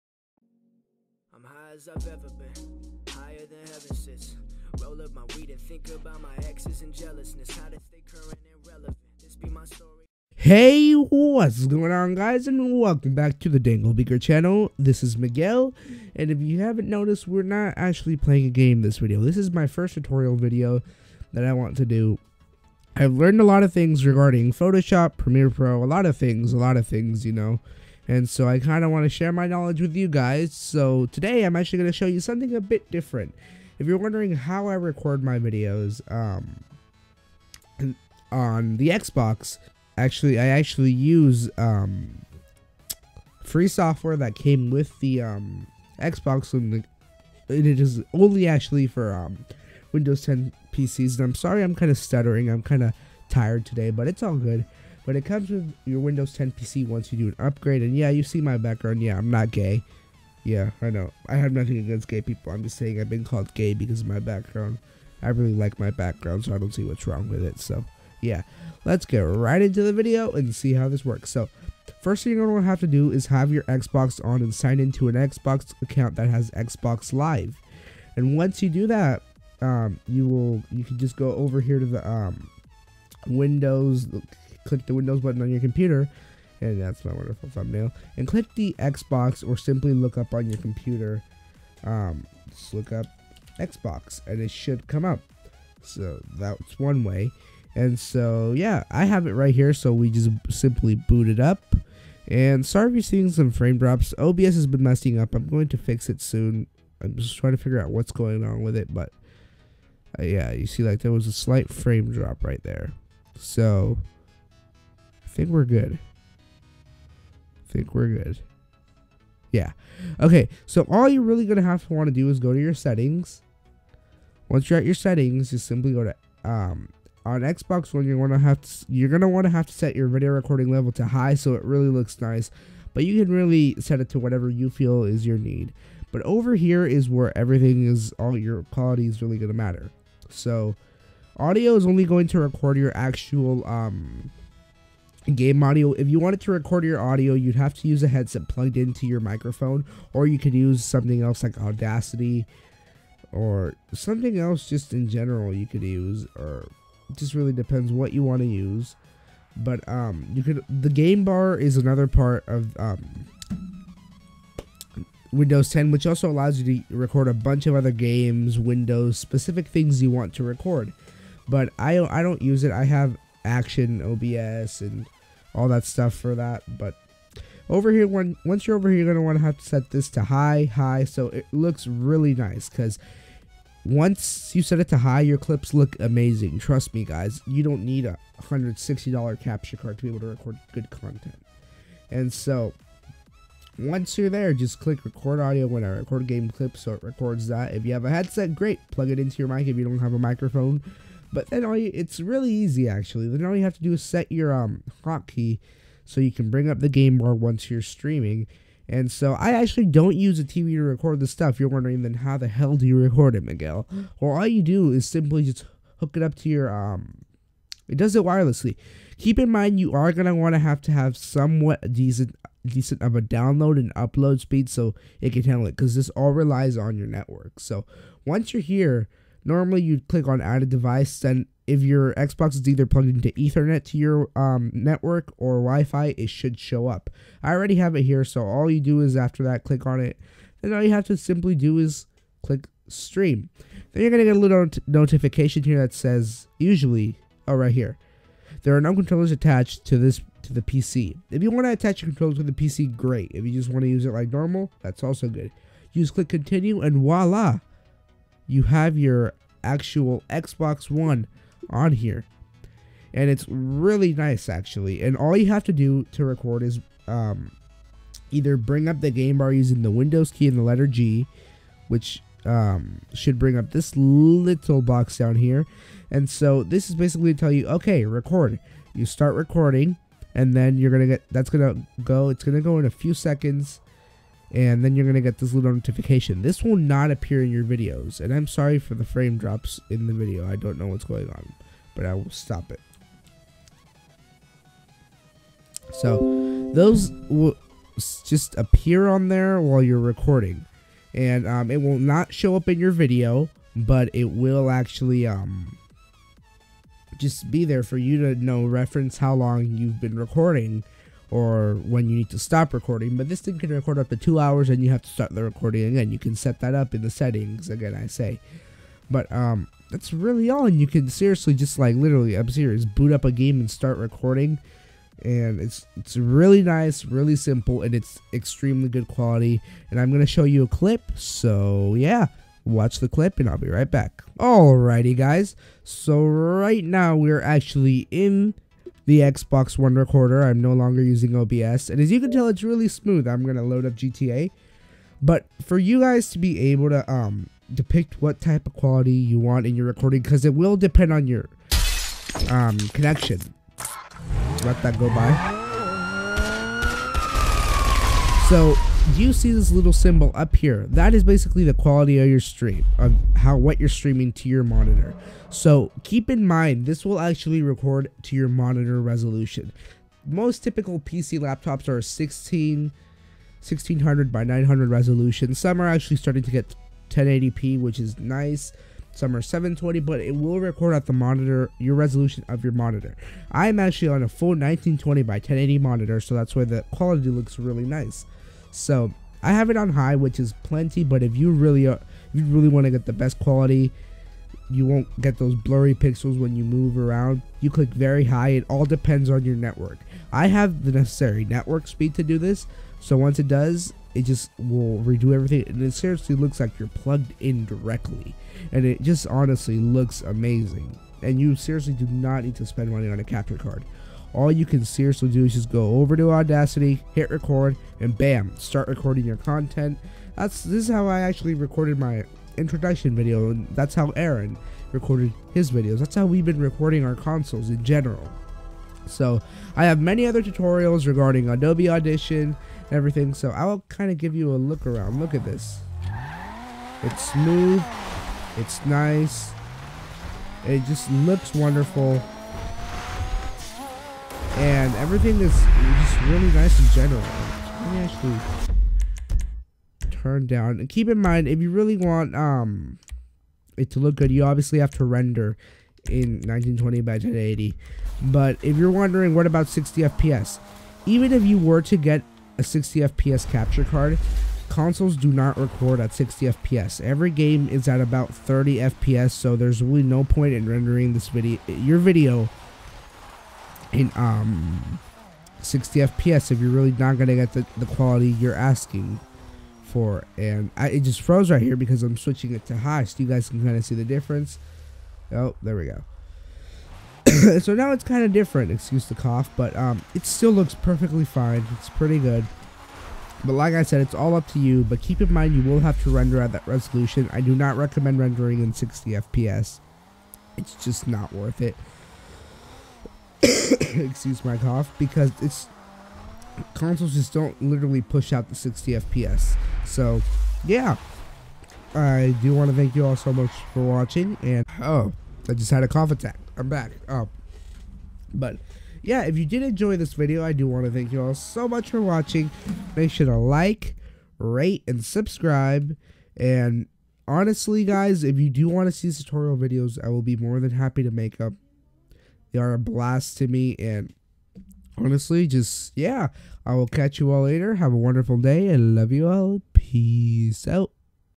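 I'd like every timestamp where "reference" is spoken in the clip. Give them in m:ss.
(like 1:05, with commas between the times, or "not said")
5:08.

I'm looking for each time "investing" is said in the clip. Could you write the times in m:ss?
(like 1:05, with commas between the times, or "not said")
not said.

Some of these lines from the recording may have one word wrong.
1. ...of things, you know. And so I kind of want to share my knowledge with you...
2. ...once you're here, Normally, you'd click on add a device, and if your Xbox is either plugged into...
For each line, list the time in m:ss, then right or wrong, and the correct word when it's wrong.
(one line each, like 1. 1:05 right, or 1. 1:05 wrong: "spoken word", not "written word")
1. 0:26 right
2. 3:48 right.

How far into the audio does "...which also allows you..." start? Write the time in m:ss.
2:45.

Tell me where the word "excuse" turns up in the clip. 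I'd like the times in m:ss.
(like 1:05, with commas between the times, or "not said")
8:08, 8:23.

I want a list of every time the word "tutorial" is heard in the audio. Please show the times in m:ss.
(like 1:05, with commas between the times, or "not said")
0:19, 7:10, 8:49.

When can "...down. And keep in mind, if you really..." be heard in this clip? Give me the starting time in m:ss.
7:30.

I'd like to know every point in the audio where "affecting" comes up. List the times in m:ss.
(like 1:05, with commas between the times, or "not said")
not said.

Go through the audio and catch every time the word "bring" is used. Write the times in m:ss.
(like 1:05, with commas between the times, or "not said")
3:26, 4:28, 4:33.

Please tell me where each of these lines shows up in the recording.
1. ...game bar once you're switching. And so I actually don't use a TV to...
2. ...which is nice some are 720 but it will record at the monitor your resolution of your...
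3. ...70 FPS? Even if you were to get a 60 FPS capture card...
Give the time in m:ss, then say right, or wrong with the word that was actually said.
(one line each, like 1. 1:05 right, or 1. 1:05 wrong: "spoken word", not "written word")
1. 3:26 wrong: "streaming", not "switching"
2. 6:17 right
3. 7:39 wrong: "60", not "70".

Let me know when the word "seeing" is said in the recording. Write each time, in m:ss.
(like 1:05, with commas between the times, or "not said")
1:43.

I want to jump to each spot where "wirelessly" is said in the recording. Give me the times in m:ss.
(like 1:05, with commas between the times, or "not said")
3:38.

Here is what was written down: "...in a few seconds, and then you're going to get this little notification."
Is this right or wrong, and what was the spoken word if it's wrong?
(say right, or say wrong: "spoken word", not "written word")
right.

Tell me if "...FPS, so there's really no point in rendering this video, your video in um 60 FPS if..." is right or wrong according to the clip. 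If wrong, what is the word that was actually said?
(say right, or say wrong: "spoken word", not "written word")
right.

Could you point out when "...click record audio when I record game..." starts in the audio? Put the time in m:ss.
3:14.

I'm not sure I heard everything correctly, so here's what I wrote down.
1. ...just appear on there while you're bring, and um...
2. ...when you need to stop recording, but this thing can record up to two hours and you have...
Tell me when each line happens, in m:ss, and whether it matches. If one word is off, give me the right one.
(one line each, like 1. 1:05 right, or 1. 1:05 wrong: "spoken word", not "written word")
1. 4:58 wrong: "recording", not "bring"
2. 5:11 right.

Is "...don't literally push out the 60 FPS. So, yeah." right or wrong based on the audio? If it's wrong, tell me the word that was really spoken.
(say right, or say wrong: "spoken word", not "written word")
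right.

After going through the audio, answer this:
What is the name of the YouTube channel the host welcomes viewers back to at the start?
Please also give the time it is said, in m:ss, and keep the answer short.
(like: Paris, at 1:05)
Dangle Beaker, at 0:13.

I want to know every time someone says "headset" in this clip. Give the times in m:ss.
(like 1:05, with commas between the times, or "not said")
2:28, 3:18.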